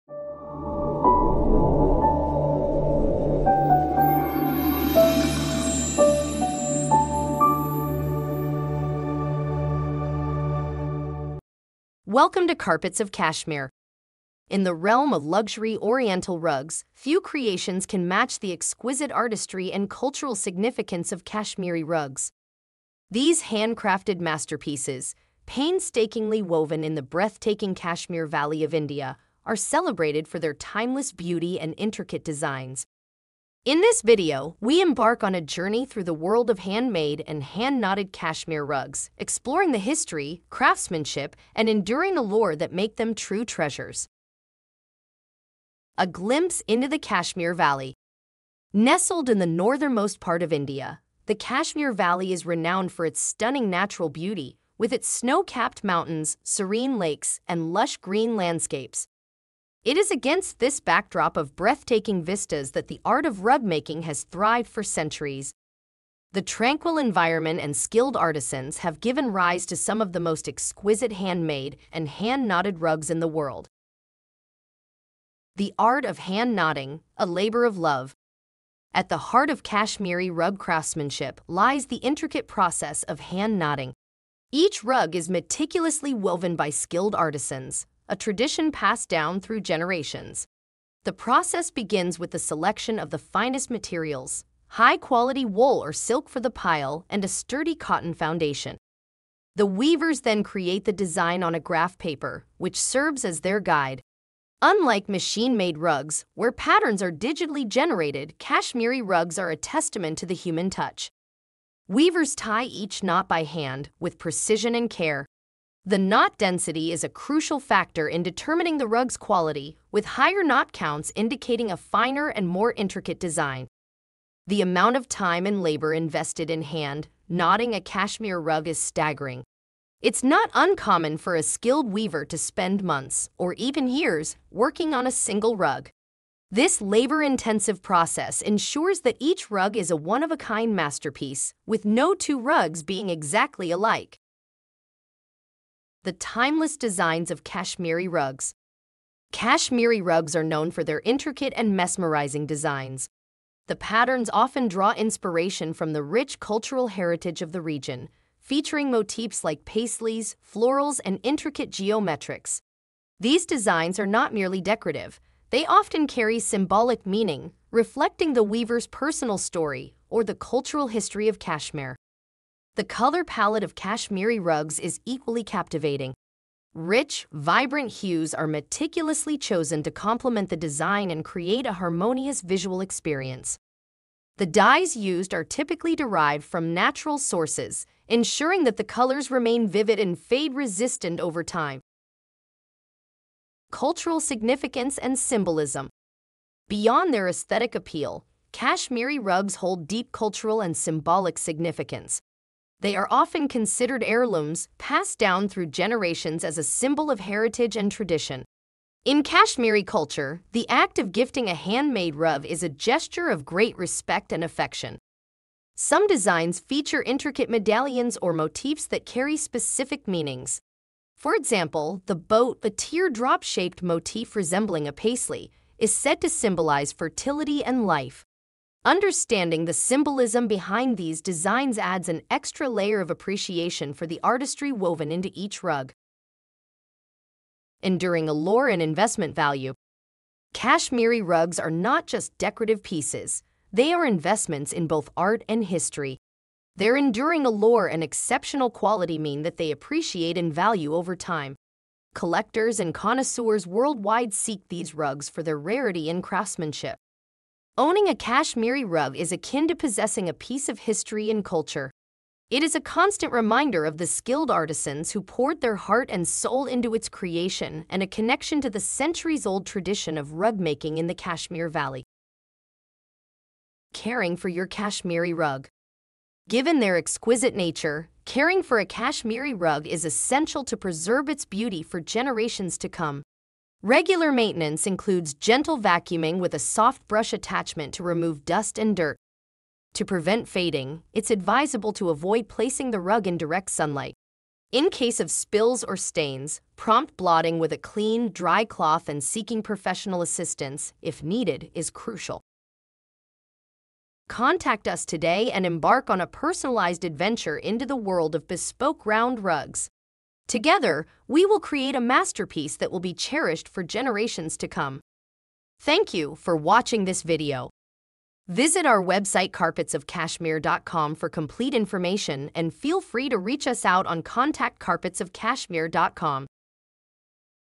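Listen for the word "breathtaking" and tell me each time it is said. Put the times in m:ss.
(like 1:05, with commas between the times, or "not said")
0:27, 1:01.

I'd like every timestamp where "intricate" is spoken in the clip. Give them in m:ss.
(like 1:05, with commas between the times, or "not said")
0:31, 1:22, 2:02, 2:31, 2:41, 3:37.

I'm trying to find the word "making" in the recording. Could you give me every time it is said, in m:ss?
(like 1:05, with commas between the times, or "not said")
1:03, 4:30.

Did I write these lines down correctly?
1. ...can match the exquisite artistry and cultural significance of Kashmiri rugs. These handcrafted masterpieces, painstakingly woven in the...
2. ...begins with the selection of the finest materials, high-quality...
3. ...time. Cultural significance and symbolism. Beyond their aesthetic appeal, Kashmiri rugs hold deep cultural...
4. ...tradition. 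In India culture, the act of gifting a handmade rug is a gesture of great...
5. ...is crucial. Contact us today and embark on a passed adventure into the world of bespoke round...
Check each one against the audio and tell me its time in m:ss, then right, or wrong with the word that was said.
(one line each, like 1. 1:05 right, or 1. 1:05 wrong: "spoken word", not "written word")
1. 0:17 right
2. 1:31 right
3. 3:11 right
4. 3:27 wrong: "Kashmiri", not "India"
5. 5:01 wrong: "personalized", not "passed".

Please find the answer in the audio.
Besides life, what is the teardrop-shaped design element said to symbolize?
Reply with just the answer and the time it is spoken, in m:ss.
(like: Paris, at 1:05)
fertility, at 3:46.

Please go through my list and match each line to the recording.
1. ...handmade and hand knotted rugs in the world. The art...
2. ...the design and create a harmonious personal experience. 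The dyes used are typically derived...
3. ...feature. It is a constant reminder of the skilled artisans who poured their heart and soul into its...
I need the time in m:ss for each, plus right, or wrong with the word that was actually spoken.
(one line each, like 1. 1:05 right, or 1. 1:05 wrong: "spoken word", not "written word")
1. 1:11 right
2. 3:00 wrong: "visual", not "personal"
3. 4:21 wrong: "culture", not "feature".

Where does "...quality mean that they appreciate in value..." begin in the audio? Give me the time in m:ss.
4:08.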